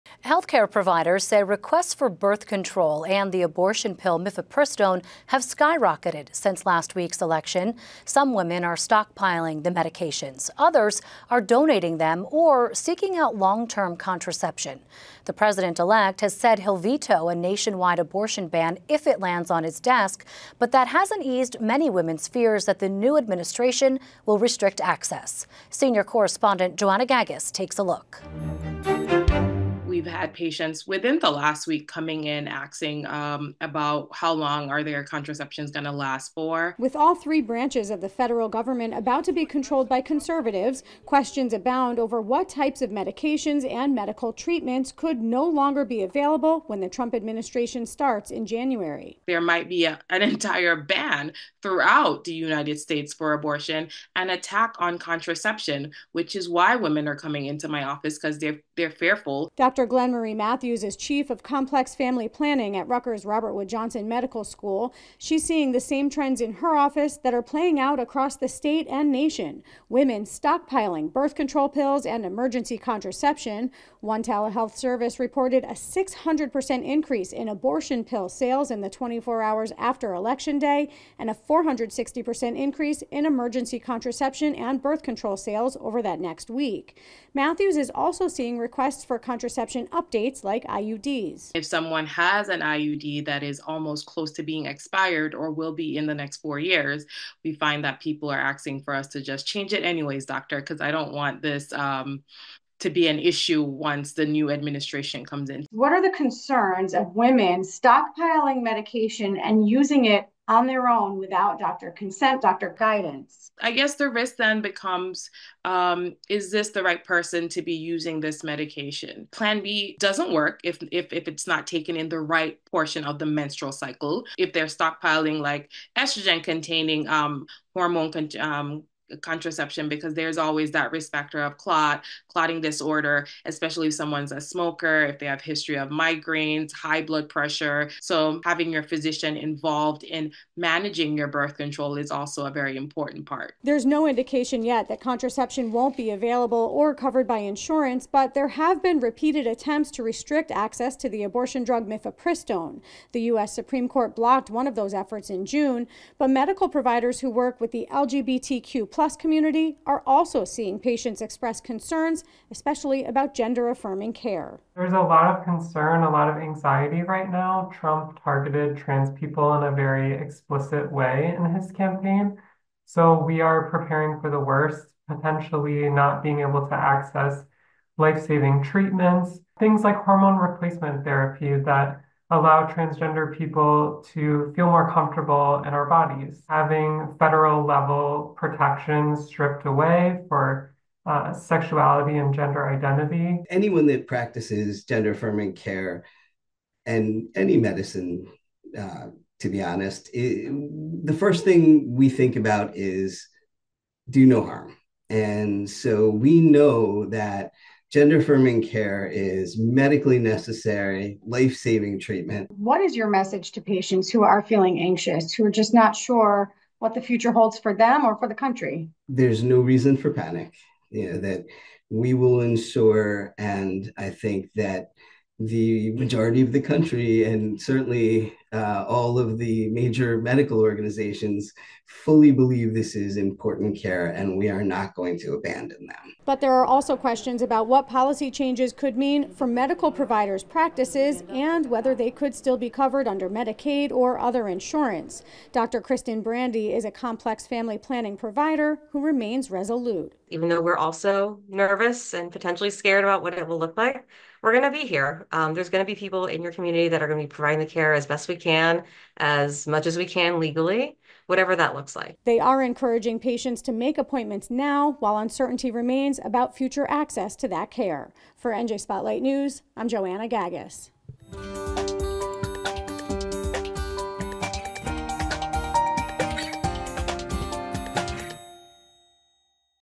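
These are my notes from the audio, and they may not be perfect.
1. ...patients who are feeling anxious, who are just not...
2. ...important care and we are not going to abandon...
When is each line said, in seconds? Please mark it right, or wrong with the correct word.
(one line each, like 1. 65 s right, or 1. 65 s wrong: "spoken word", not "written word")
1. 213 s right
2. 233 s right.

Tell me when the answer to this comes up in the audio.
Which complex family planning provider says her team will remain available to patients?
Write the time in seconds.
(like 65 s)
245 s.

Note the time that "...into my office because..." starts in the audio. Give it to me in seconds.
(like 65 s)
57 s.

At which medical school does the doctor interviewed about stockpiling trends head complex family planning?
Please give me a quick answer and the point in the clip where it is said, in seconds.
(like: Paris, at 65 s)
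Rutgers Robert Wood Johnson Medical School, at 62 s.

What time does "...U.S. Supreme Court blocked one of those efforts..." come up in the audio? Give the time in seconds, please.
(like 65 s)
153 s.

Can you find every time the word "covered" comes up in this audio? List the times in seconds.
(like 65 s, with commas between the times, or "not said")
146 s, 242 s.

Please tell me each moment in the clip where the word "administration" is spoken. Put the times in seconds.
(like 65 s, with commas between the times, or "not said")
23 s, 47 s, 104 s.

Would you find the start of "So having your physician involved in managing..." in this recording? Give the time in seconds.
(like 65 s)
138 s.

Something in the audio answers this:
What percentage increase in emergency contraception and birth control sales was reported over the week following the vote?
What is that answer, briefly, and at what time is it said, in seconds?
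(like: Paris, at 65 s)
460%, at 81 s.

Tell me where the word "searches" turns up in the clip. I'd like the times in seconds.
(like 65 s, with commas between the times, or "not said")
not said.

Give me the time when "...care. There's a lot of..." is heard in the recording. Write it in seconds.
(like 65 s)
164 s.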